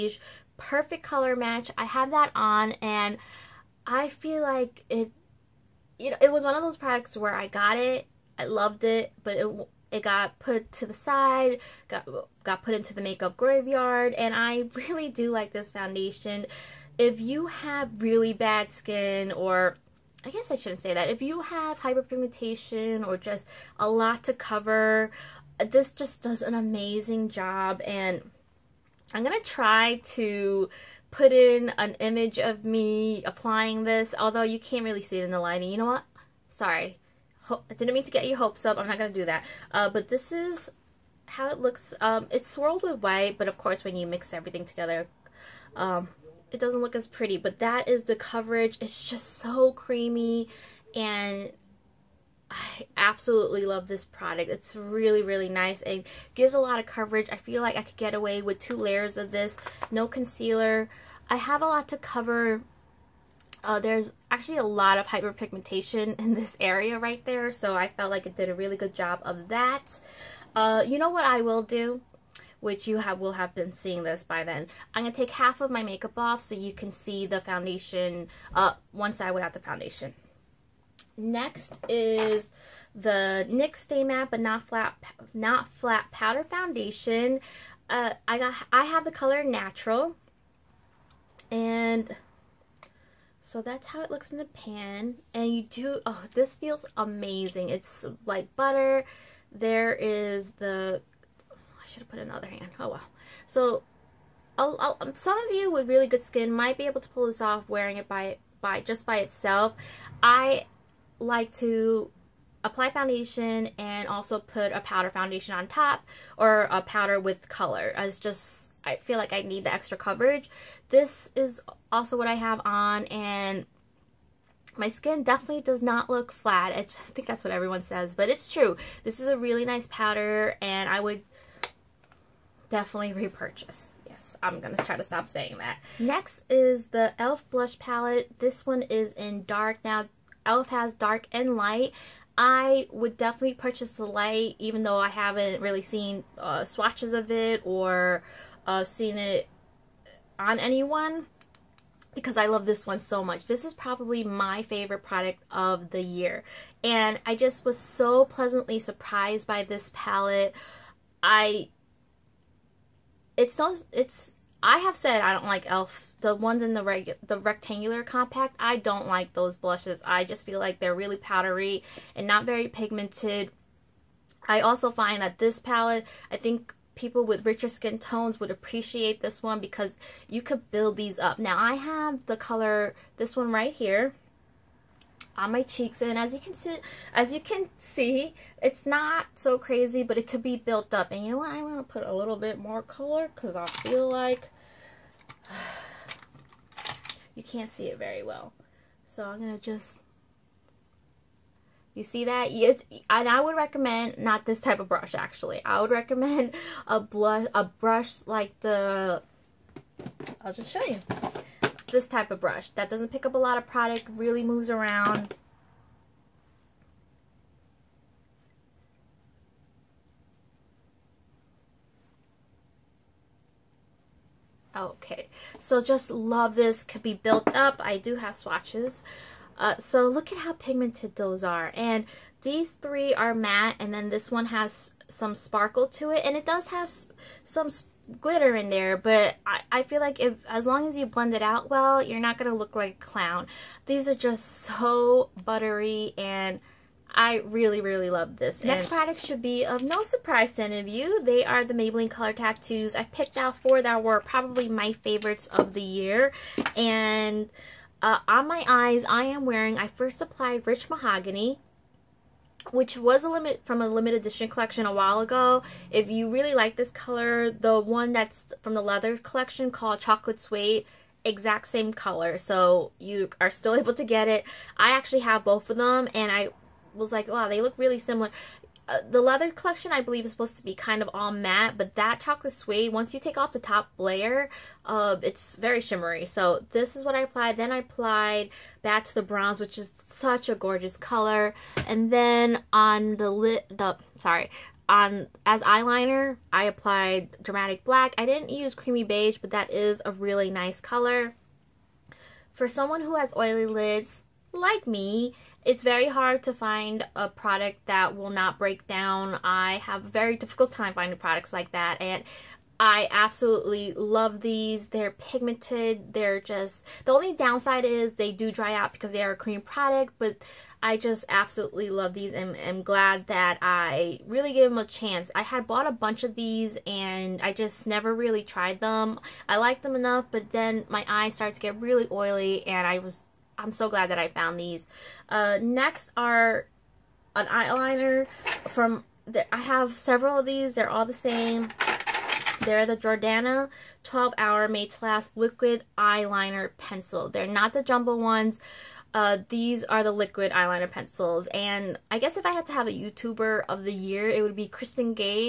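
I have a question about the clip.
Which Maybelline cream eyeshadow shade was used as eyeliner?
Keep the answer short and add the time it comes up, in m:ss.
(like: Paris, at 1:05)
Dramatic Black, at 4:57.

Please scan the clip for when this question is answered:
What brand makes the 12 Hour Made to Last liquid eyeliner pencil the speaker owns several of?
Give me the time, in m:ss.
5:42.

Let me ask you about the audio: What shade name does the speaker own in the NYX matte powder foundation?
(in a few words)
Natural.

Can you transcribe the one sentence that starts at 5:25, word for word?
I had bought a bunch of these and I just never really tried them.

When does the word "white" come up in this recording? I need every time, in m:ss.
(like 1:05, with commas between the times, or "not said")
0:43.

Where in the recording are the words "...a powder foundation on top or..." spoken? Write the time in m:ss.
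1:54.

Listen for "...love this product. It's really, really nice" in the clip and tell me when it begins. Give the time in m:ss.
0:53.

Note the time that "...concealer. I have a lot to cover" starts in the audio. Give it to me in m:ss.
1:00.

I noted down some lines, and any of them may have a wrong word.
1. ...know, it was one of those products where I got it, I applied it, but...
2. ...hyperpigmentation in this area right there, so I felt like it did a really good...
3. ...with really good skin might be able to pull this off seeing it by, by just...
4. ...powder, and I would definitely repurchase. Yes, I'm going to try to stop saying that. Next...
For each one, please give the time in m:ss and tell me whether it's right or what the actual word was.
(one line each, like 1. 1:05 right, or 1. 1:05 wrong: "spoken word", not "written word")
1. 0:06 wrong: "loved", not "applied"
2. 1:05 right
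3. 1:45 wrong: "wearing", not "seeing"
4. 2:09 right.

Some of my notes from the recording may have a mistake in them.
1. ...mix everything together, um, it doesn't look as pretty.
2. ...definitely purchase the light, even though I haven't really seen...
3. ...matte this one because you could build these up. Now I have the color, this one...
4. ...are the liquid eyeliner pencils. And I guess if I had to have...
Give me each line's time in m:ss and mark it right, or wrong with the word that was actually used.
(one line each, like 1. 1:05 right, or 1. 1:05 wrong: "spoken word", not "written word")
1. 0:44 right
2. 2:23 right
3. 2:58 wrong: "appreciate", not "matte"
4. 5:49 right.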